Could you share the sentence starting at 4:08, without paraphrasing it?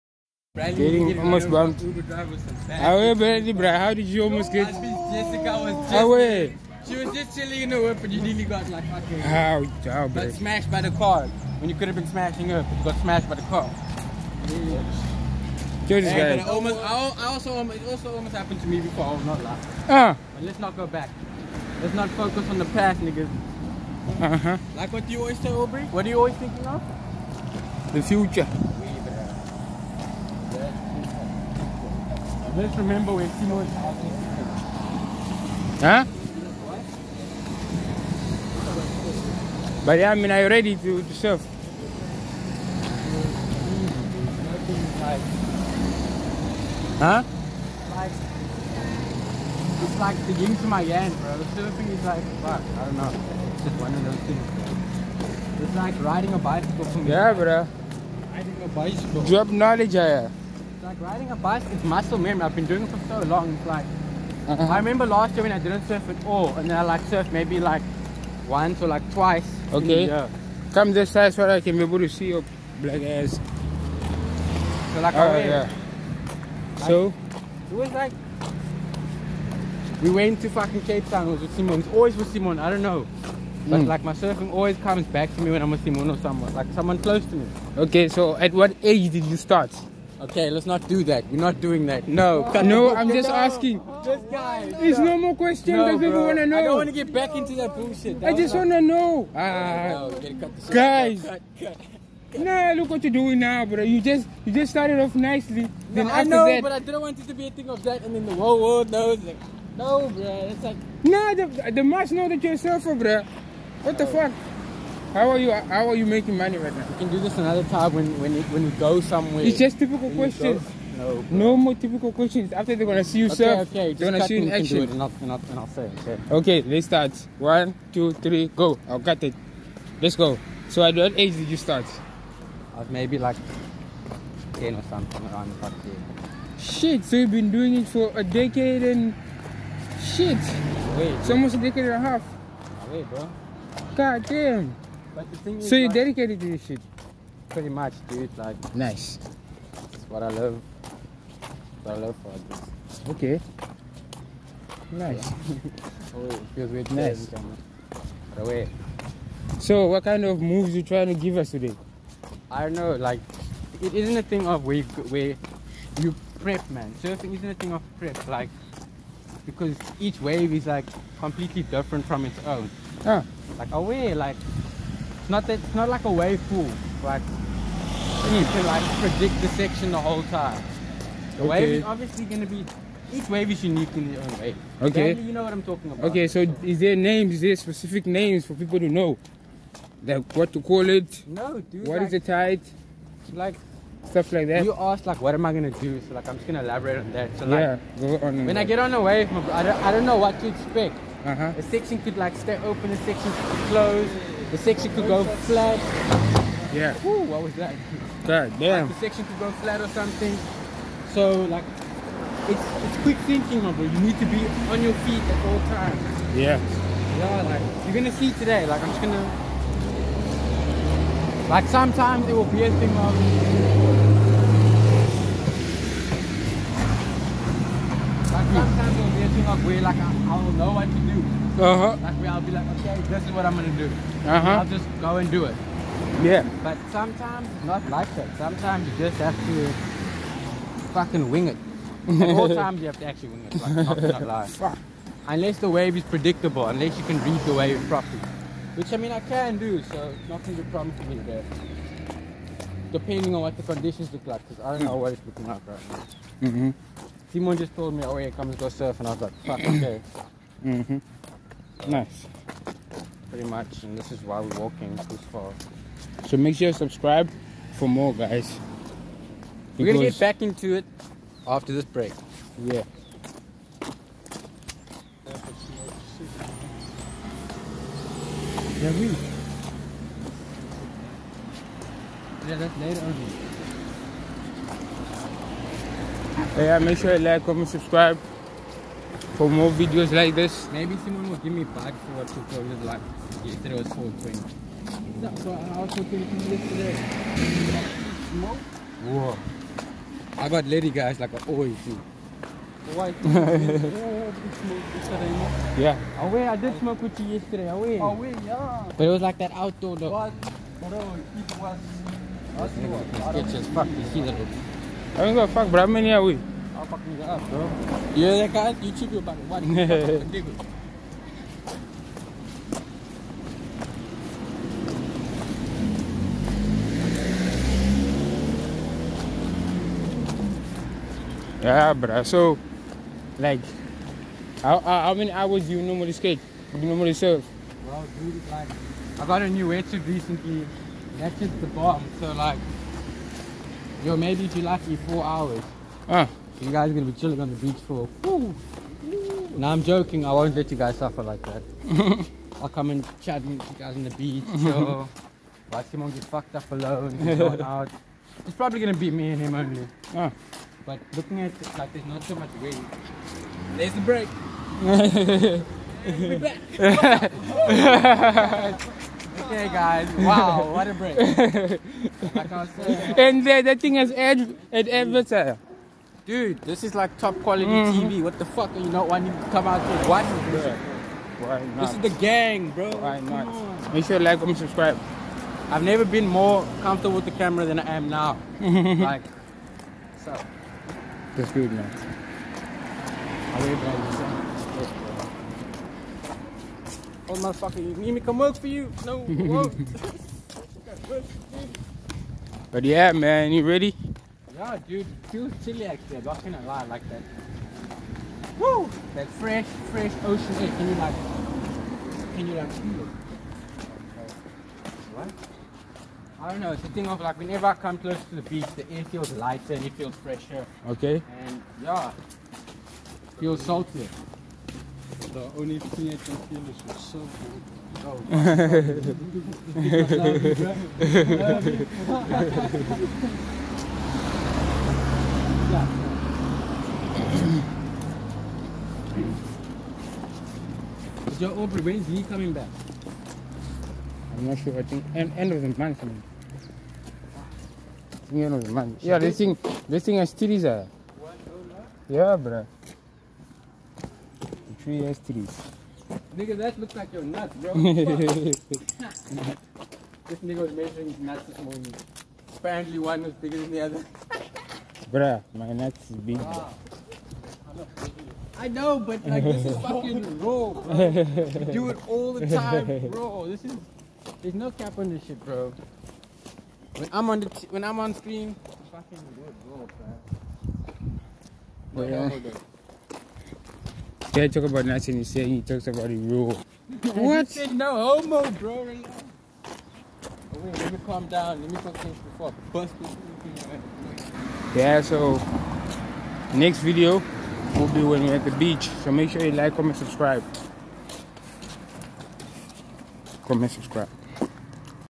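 Which I mean I can do, so it's not gonna be a problem for me there.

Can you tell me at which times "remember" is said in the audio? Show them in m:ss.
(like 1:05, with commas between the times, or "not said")
0:32, 1:04.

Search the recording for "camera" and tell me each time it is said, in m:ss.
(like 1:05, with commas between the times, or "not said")
6:27.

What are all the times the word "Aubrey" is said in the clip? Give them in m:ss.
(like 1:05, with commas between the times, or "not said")
0:25, 7:21.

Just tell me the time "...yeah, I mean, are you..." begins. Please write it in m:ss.
0:39.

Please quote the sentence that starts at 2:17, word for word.
So you've been doing it for a decade and shit.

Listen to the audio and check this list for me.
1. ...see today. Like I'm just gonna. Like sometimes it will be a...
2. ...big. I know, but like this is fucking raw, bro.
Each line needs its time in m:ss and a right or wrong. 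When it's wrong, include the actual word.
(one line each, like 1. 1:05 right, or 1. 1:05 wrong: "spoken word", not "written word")
1. 3:38 right
2. 7:46 right.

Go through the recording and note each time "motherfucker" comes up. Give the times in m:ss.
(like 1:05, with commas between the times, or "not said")
6:37.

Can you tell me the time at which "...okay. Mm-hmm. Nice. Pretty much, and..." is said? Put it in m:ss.
4:19.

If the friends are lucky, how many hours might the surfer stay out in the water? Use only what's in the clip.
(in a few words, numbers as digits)
4.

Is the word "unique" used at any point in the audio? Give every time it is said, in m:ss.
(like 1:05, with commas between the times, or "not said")
3:03.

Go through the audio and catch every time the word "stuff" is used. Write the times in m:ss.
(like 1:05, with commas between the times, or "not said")
3:14.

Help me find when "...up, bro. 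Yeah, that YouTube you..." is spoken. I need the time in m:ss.
5:17.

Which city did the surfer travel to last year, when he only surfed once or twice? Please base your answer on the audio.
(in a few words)
Cape Town.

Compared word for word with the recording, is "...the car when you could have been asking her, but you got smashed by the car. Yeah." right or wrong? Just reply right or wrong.
wrong.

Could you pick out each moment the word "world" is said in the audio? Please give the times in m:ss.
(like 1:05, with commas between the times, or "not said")
1:48.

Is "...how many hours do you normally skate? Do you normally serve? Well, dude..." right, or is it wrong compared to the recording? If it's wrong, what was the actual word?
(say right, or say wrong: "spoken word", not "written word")
right.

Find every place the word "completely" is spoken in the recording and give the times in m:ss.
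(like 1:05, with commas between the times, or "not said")
2:51.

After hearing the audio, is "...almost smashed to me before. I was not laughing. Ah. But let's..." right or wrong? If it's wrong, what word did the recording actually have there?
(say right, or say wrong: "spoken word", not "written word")
wrong: "happened", not "smashed".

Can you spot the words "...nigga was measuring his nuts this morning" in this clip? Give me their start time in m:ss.
7:40.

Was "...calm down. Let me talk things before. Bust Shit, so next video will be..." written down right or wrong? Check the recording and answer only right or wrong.
wrong.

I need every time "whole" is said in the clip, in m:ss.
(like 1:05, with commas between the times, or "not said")
1:48, 2:59.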